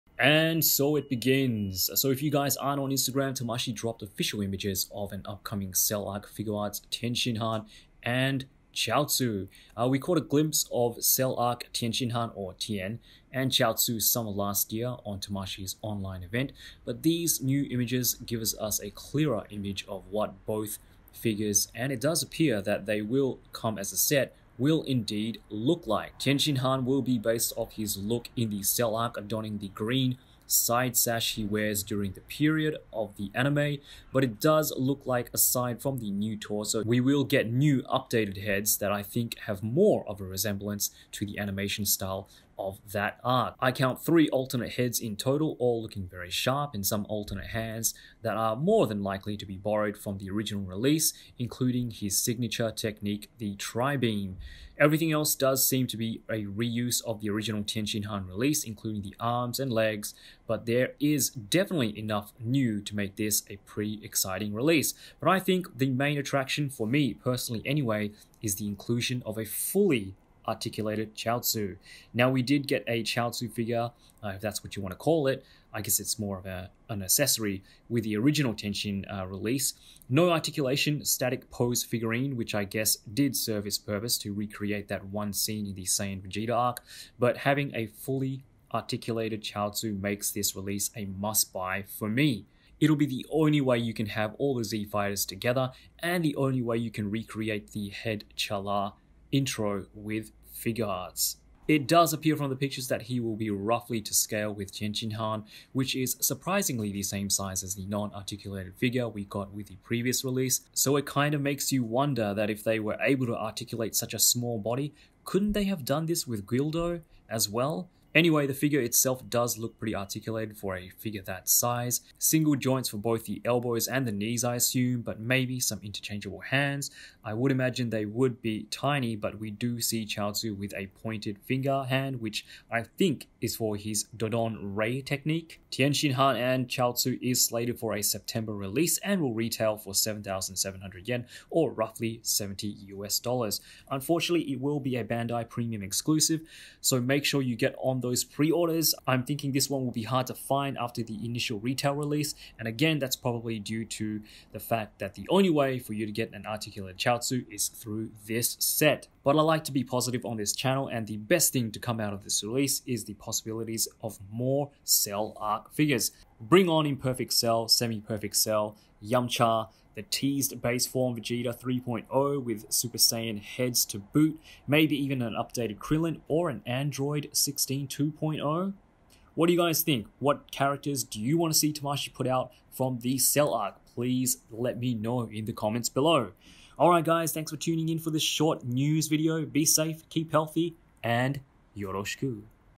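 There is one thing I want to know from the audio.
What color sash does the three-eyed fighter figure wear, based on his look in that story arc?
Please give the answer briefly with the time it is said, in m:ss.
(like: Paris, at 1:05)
Green, at 0:29.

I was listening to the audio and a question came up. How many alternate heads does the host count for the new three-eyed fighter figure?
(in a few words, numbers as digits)
3.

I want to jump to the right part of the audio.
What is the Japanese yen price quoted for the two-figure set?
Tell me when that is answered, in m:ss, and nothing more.
2:19.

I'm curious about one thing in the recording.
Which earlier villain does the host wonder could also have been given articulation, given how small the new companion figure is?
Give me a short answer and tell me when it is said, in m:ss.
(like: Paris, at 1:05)
Guldo, at 1:56.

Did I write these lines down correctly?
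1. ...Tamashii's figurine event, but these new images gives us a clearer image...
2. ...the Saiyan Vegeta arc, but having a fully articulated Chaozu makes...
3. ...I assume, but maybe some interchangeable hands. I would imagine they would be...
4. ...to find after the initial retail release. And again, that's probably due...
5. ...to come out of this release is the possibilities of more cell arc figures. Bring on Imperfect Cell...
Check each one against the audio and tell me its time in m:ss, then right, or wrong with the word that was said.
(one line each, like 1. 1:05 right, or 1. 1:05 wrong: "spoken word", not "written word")
1. 0:15 wrong: "online", not "figurine"
2. 1:25 right
3. 2:04 right
4. 2:30 right
5. 2:41 right.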